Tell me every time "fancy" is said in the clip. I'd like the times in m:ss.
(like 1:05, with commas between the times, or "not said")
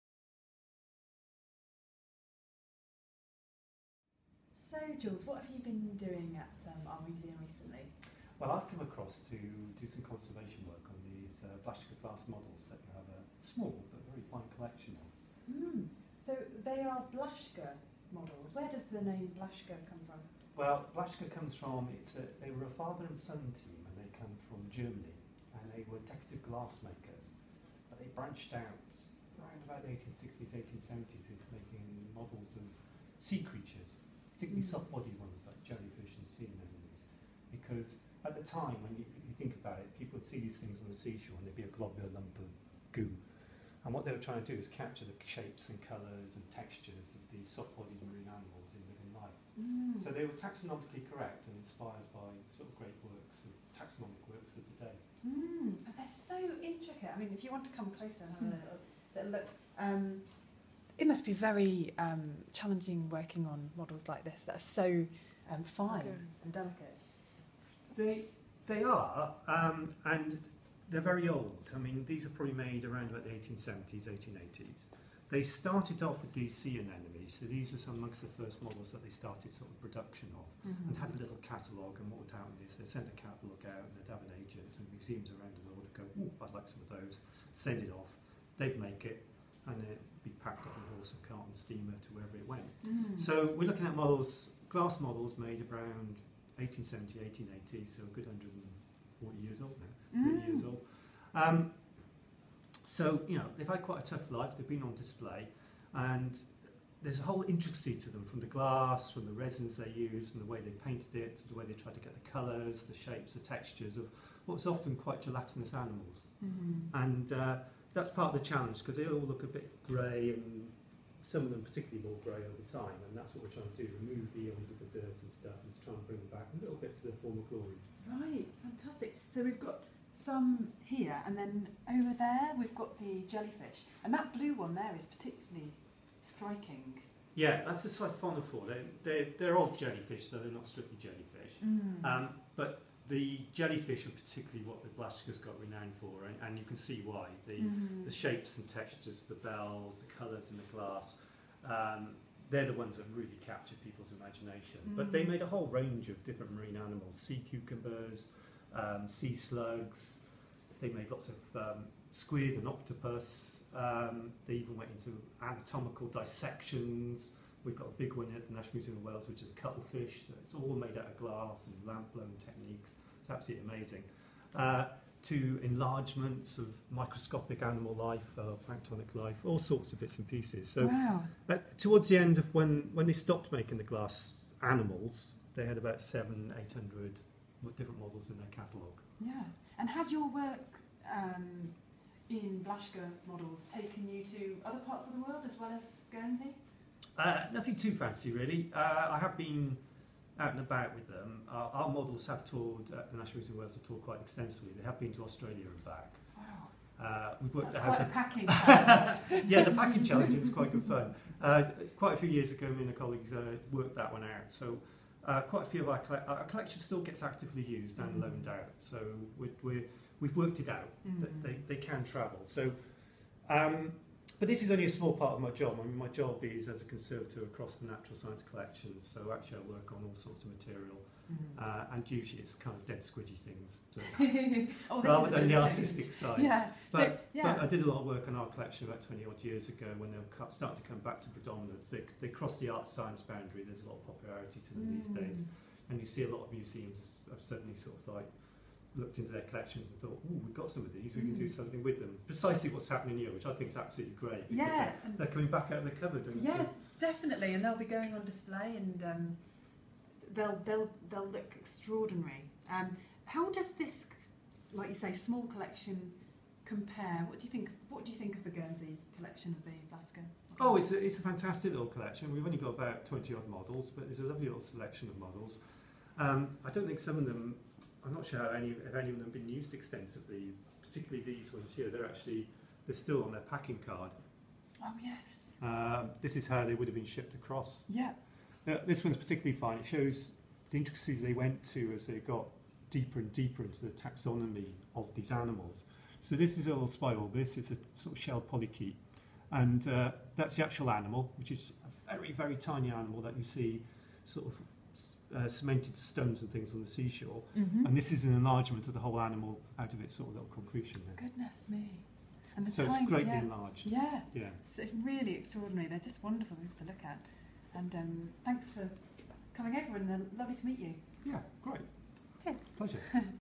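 3:17.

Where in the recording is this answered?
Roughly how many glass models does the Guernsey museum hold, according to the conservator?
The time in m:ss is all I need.
4:33.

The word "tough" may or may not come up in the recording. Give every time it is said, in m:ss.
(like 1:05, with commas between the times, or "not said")
1:44.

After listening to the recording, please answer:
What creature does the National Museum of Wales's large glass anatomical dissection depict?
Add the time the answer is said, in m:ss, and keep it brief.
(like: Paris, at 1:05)
Cuttlefish, at 2:49.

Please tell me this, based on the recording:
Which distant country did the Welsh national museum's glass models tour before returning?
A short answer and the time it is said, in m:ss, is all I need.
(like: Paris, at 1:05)
Australia, at 3:25.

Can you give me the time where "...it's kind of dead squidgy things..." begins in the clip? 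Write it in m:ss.
3:52.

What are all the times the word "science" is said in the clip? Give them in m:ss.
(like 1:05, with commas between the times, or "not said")
3:48, 4:02.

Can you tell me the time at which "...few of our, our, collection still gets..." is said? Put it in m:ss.
3:35.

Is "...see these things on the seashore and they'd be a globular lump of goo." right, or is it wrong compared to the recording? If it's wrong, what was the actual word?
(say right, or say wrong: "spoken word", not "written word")
right.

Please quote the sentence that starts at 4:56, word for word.
So this is a little spiral this is a sort of shell polychaete.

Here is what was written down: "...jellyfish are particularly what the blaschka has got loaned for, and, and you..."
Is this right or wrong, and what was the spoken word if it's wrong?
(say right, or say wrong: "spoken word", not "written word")
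wrong: "renowned", not "loaned".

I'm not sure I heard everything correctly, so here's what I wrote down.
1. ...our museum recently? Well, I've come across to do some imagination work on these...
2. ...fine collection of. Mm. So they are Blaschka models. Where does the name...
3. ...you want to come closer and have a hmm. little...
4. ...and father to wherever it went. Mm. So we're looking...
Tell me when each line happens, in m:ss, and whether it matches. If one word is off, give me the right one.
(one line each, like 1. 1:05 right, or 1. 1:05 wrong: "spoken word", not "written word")
1. 0:06 wrong: "conservation", not "imagination"
2. 0:14 right
3. 0:57 right
4. 1:31 wrong: "steamer", not "father".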